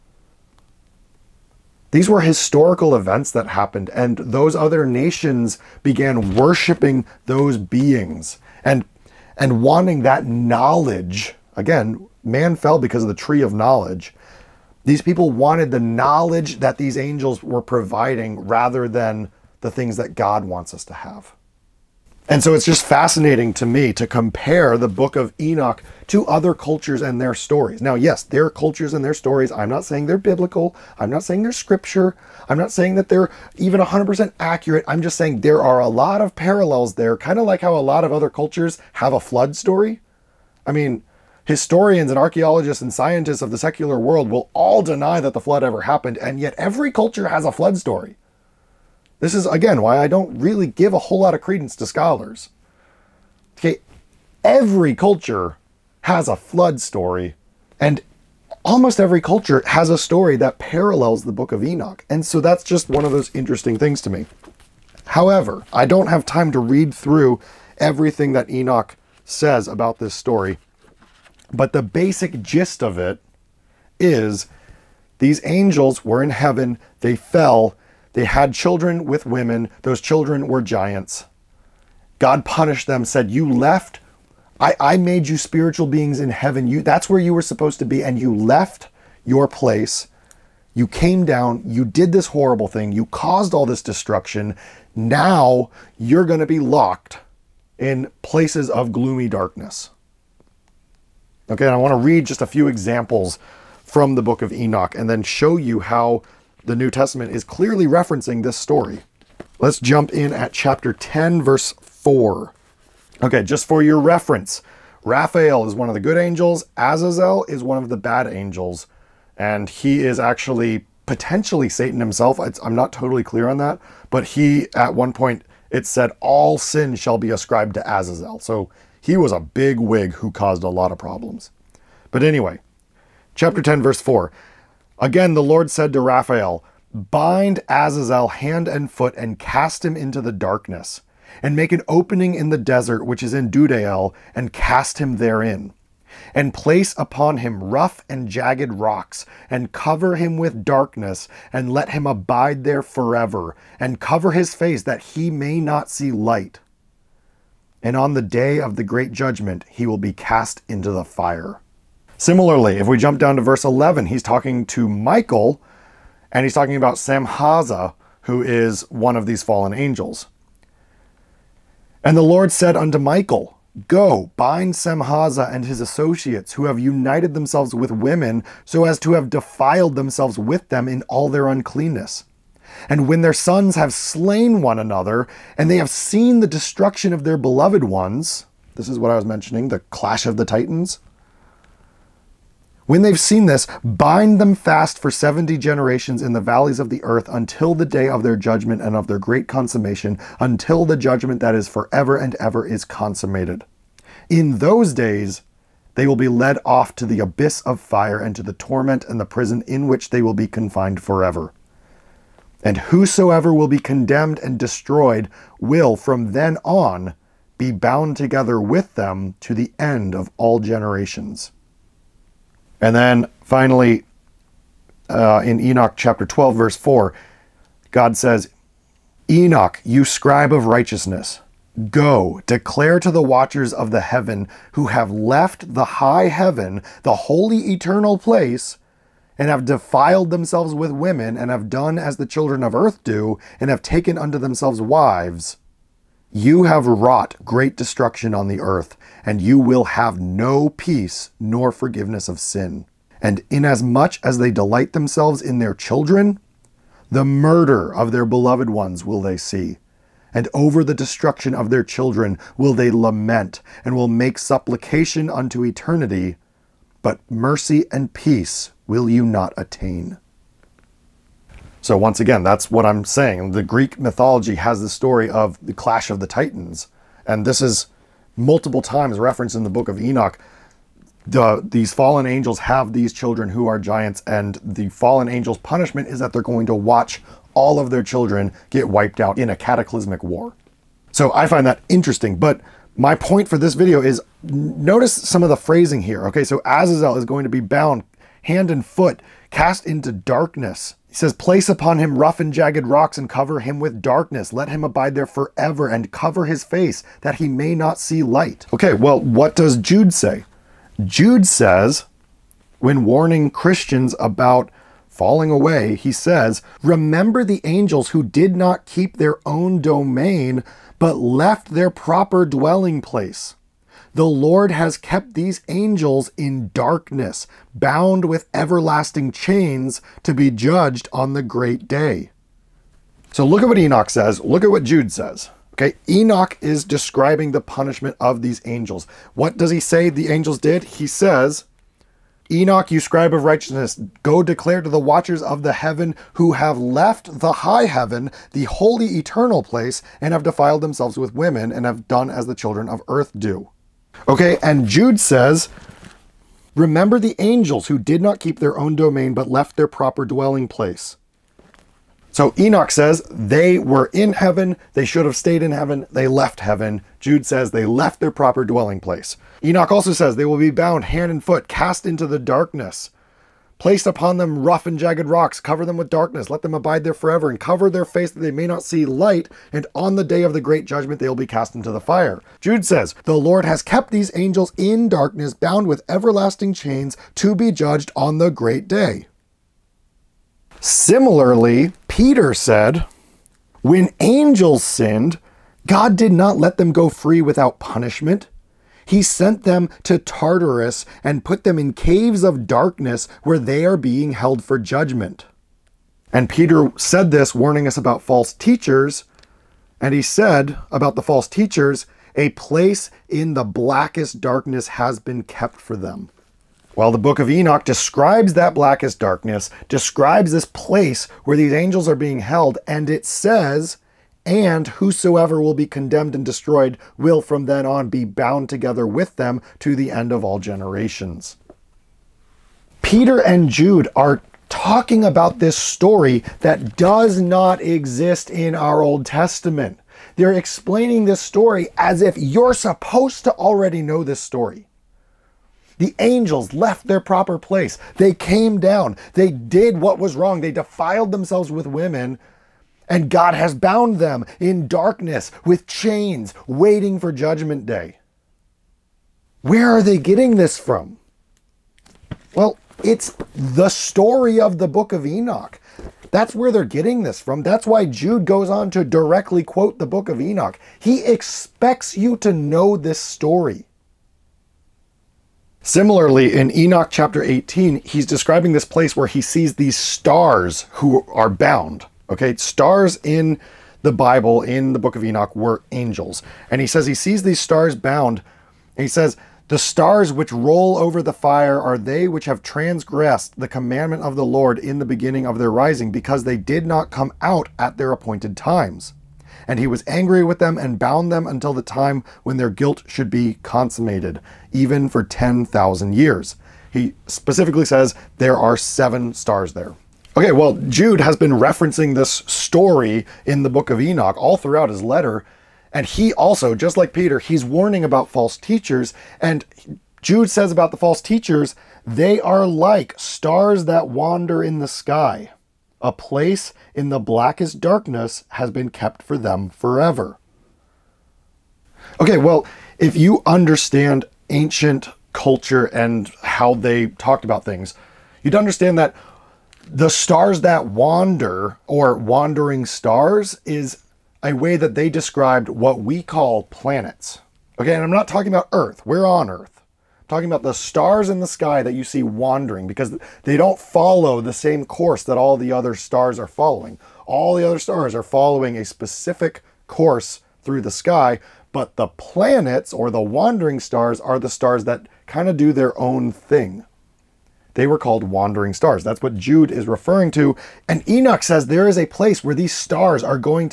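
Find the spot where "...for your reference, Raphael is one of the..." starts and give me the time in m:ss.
1:53.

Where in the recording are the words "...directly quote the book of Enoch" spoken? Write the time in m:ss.
7:49.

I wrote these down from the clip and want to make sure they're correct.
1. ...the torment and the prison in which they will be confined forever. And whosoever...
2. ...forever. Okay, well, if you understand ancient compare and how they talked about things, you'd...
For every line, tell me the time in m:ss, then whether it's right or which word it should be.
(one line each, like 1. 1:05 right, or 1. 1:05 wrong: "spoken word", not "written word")
1. 3:28 right
2. 8:49 wrong: "culture", not "compare".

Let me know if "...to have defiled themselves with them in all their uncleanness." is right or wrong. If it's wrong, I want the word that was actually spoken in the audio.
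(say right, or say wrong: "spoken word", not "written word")
right.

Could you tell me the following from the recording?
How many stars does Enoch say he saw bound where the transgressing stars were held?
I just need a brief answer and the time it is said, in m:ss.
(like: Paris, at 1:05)
7, at 8:28.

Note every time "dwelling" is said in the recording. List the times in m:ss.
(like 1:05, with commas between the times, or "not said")
5:22, 6:00, 6:08.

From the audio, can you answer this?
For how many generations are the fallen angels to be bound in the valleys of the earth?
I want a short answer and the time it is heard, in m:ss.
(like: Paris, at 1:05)
70, at 3:15.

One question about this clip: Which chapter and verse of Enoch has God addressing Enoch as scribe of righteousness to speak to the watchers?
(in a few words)
Chapter 12, verse 4.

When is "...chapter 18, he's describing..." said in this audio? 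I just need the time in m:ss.
7:57.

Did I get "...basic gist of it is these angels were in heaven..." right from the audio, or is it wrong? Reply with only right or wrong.
right.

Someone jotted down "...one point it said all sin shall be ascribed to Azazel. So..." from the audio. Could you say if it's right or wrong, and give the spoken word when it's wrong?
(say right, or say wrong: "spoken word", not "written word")
right.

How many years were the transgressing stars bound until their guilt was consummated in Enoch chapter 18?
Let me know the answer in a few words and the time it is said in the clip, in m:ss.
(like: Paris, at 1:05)
10,000, at 8:25.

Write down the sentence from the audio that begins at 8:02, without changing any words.
Okay, stars in the Bible, in the book of Enoch, were angels.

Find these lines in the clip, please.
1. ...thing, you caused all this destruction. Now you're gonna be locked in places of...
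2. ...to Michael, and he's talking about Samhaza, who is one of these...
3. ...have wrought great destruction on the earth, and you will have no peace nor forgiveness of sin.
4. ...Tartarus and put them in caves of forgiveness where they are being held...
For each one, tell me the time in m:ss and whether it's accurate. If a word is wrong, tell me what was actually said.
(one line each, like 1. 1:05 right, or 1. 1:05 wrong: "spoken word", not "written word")
1. 1:32 right
2. 2:44 right
3. 4:06 right
4. 6:40 wrong: "darkness", not "forgiveness".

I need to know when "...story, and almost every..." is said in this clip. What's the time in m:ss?
0:56.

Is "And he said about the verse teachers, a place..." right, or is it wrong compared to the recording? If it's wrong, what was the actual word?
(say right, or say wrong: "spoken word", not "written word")
wrong: "false", not "verse".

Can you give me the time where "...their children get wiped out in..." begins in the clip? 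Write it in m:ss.
4:47.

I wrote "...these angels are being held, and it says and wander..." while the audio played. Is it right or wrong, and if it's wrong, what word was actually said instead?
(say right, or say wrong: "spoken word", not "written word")
wrong: "whosoever", not "wander".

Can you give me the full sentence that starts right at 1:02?
And so that's just one of those interesting things to me.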